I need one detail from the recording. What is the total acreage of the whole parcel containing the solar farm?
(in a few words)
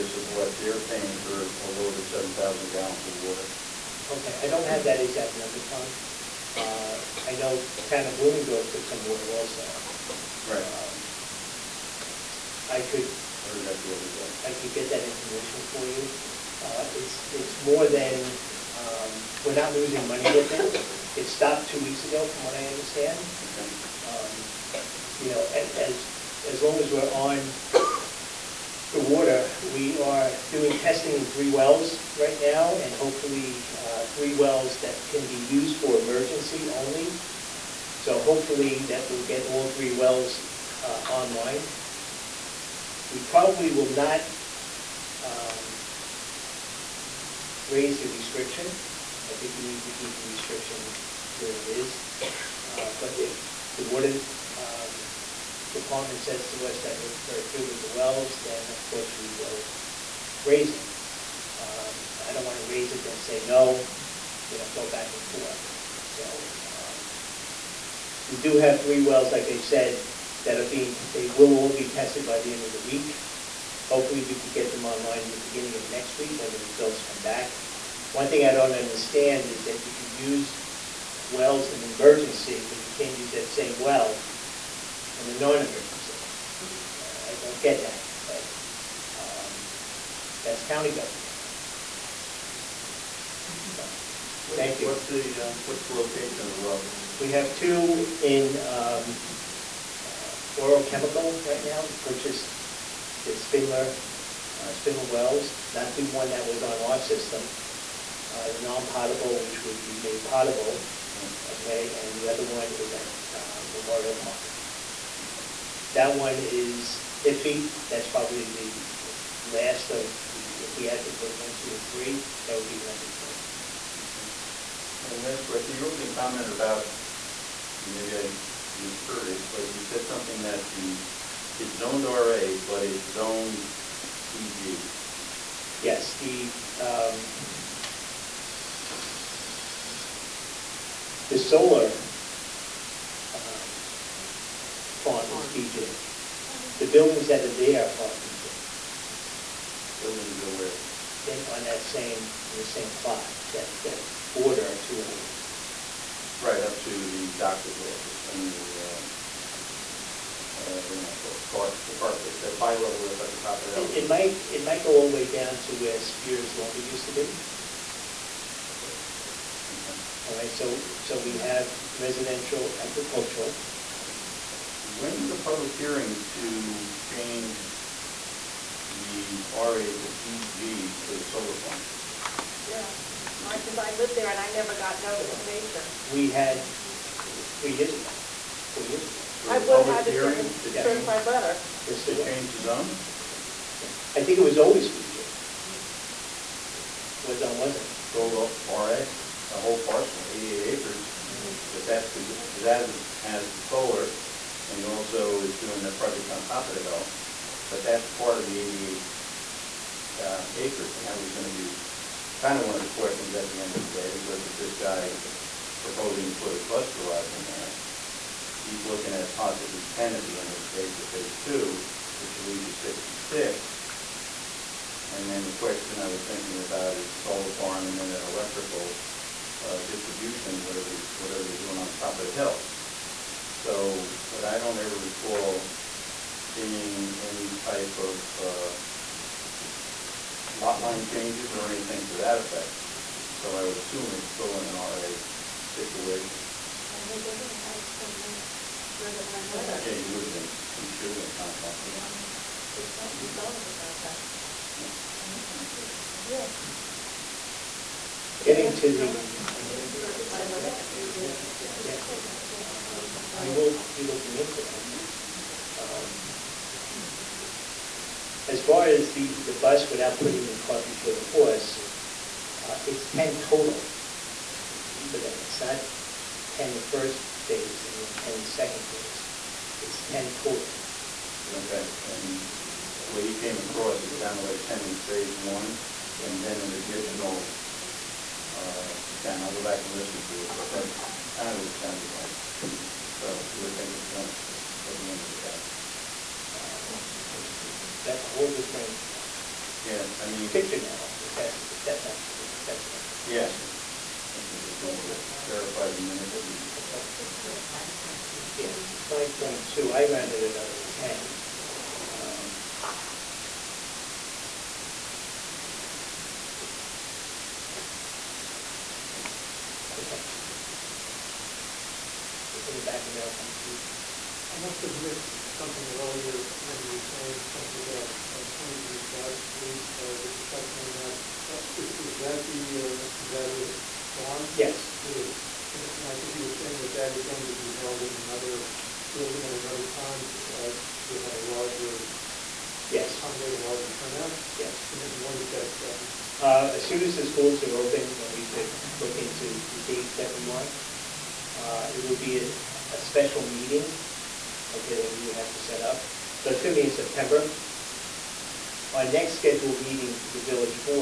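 88 acres.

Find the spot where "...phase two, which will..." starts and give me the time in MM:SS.
03:41.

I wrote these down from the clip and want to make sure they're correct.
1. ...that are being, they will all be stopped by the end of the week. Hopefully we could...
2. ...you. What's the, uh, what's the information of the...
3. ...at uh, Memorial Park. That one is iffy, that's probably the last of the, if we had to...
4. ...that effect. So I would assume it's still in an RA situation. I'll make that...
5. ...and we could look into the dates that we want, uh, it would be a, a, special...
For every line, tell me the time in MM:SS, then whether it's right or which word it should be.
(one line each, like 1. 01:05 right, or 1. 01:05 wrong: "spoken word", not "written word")
1. 01:10 wrong: "tested", not "stopped"
2. 01:34 wrong: "location", not "information"
3. 01:52 right
4. 04:02 right
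5. 05:48 right.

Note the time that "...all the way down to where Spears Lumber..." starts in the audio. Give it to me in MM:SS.
02:44.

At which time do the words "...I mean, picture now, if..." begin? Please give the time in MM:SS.
05:00.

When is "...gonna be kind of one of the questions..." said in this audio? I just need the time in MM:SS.
03:31.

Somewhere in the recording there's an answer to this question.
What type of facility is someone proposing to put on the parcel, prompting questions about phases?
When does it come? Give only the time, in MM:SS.
03:36.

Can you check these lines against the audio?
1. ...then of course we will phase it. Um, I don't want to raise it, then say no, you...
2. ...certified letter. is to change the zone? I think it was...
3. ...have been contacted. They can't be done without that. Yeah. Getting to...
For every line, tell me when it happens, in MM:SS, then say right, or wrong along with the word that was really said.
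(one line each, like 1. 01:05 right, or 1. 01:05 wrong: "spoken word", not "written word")
1. 00:58 wrong: "raise", not "phase"
2. 03:10 right
3. 04:11 right.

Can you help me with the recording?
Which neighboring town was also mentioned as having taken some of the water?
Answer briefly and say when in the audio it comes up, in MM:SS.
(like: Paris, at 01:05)
Blooming Grove, at 00:08.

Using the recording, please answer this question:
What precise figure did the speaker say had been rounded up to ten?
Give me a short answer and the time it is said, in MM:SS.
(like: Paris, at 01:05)
9.2, at 05:09.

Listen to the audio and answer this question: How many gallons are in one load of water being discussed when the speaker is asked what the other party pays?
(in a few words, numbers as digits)
7,000.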